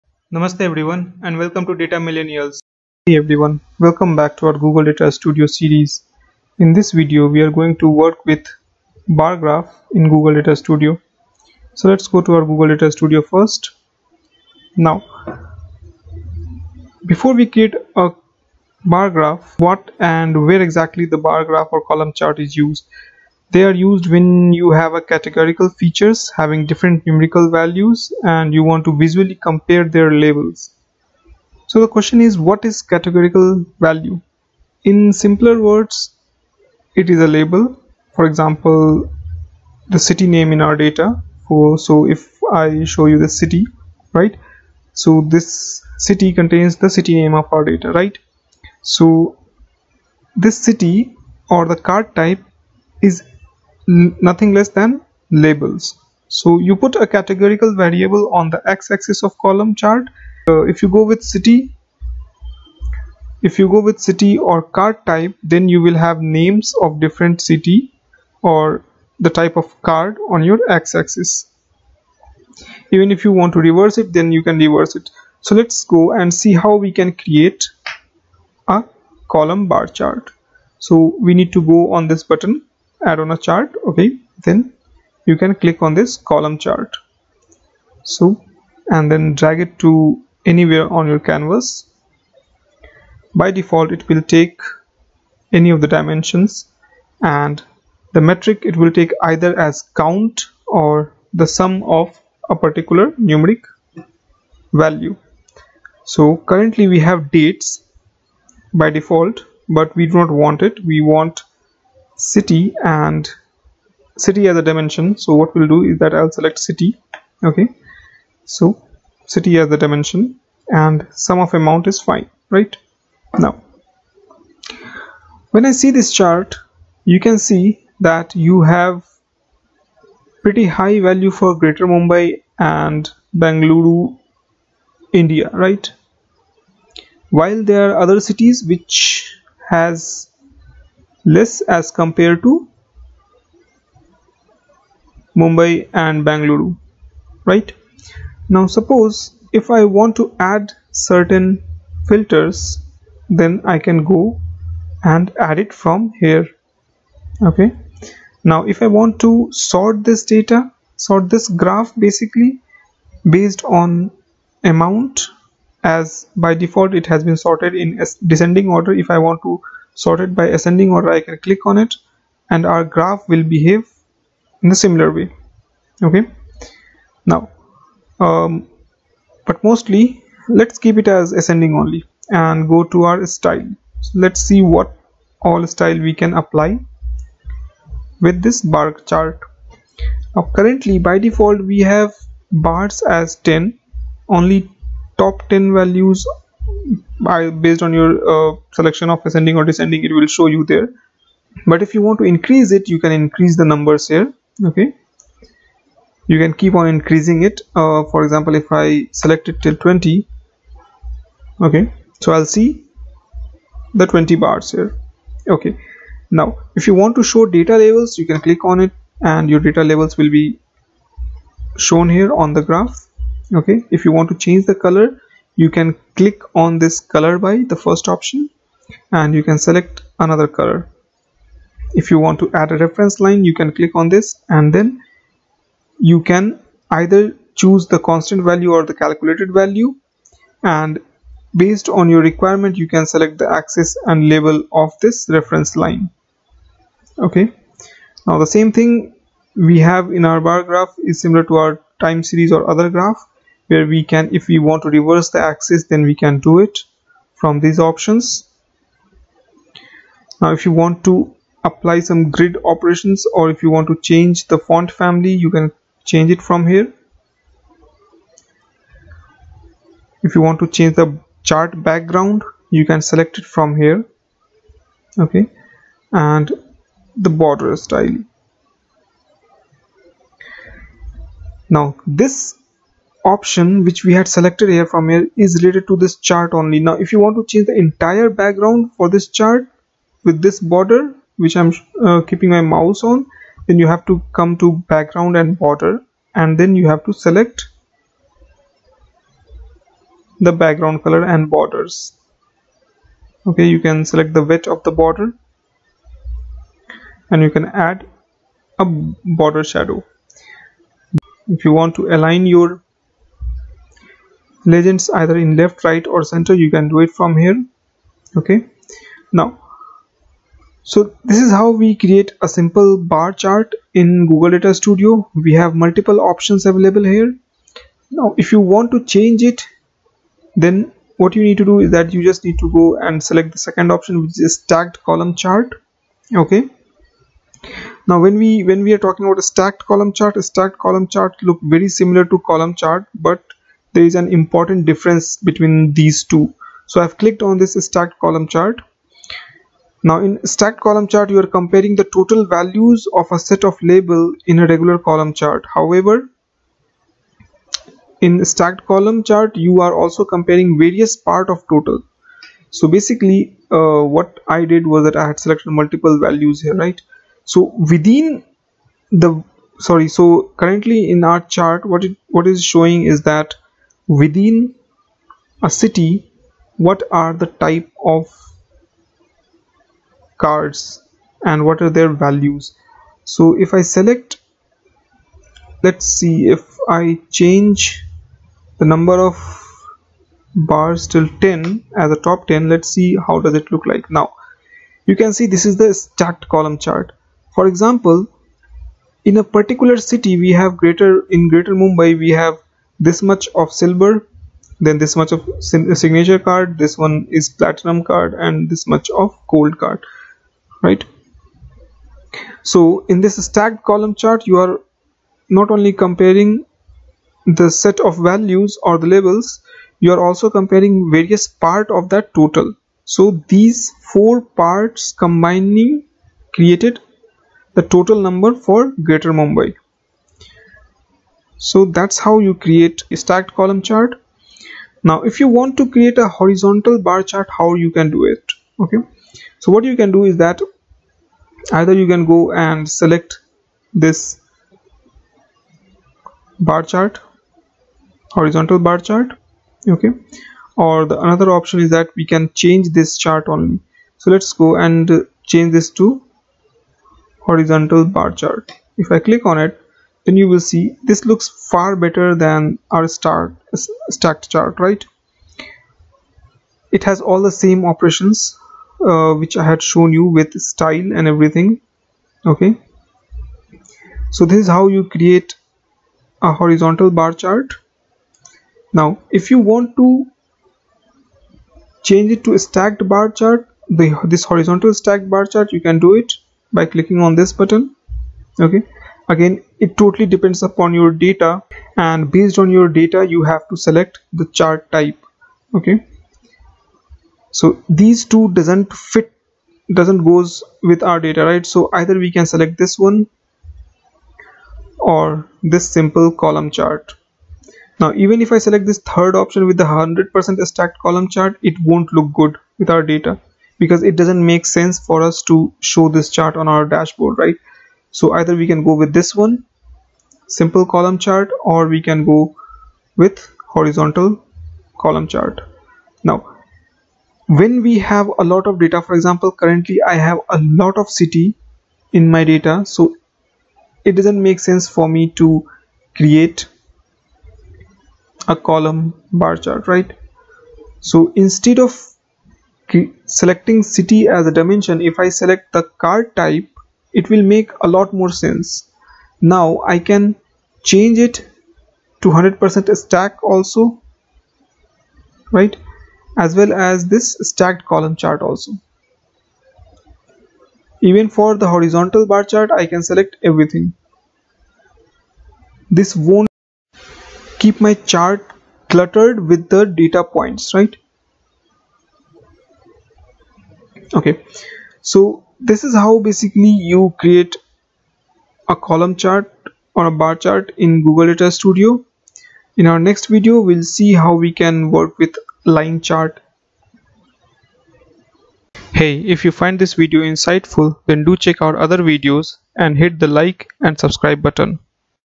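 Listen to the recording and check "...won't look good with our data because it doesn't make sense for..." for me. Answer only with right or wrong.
right.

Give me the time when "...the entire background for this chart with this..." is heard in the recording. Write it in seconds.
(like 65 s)
287 s.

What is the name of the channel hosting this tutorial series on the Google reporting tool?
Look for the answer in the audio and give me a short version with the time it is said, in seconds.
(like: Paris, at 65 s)
Data Millennials, at 1 s.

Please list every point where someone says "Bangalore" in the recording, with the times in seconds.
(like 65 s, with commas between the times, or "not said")
133 s, 146 s.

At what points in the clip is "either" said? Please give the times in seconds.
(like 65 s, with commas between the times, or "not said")
99 s, 236 s, 315 s, 441 s, 501 s, 518 s.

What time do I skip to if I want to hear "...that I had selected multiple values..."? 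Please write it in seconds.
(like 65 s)
365 s.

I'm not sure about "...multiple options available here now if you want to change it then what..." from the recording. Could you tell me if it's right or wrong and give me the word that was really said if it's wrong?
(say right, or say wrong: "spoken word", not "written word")
right.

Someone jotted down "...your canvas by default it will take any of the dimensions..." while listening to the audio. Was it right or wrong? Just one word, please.
right.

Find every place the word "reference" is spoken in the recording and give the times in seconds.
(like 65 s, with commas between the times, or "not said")
232 s, 245 s.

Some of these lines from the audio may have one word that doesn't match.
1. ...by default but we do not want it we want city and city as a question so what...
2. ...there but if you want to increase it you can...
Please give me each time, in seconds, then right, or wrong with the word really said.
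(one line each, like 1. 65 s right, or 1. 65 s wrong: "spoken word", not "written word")
1. 108 s wrong: "dimension", not "question"
2. 200 s right.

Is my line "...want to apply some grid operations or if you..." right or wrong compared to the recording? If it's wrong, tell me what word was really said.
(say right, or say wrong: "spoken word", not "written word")
right.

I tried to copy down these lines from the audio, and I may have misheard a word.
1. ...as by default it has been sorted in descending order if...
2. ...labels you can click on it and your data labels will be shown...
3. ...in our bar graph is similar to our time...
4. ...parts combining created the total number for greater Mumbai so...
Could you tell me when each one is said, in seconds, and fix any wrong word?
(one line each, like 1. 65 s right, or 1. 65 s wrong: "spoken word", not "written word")
1. 165 s right
2. 217 s right
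3. 250 s right
4. 424 s right.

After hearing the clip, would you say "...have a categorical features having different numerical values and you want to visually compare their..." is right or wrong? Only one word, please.
right.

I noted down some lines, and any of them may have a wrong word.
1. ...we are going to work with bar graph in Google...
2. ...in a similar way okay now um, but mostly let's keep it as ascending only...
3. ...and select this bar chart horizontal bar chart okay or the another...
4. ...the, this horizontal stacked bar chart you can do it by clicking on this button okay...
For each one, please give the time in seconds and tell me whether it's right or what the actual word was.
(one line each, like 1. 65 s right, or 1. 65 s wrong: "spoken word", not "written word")
1. 7 s right
2. 174 s right
3. 442 s right
4. 483 s right.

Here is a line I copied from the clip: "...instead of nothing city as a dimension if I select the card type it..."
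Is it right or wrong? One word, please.
wrong.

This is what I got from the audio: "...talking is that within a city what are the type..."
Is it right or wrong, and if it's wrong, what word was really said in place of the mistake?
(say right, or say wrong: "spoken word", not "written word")
wrong: "showing", not "talking".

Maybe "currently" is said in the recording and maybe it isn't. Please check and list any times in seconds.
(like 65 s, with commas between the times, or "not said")
106 s, 190 s, 370 s, 529 s.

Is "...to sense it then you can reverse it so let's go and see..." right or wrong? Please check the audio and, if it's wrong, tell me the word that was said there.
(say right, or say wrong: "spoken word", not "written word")
wrong: "reverse", not "sense".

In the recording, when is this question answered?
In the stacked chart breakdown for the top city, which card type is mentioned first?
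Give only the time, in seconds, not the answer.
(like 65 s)
403 s.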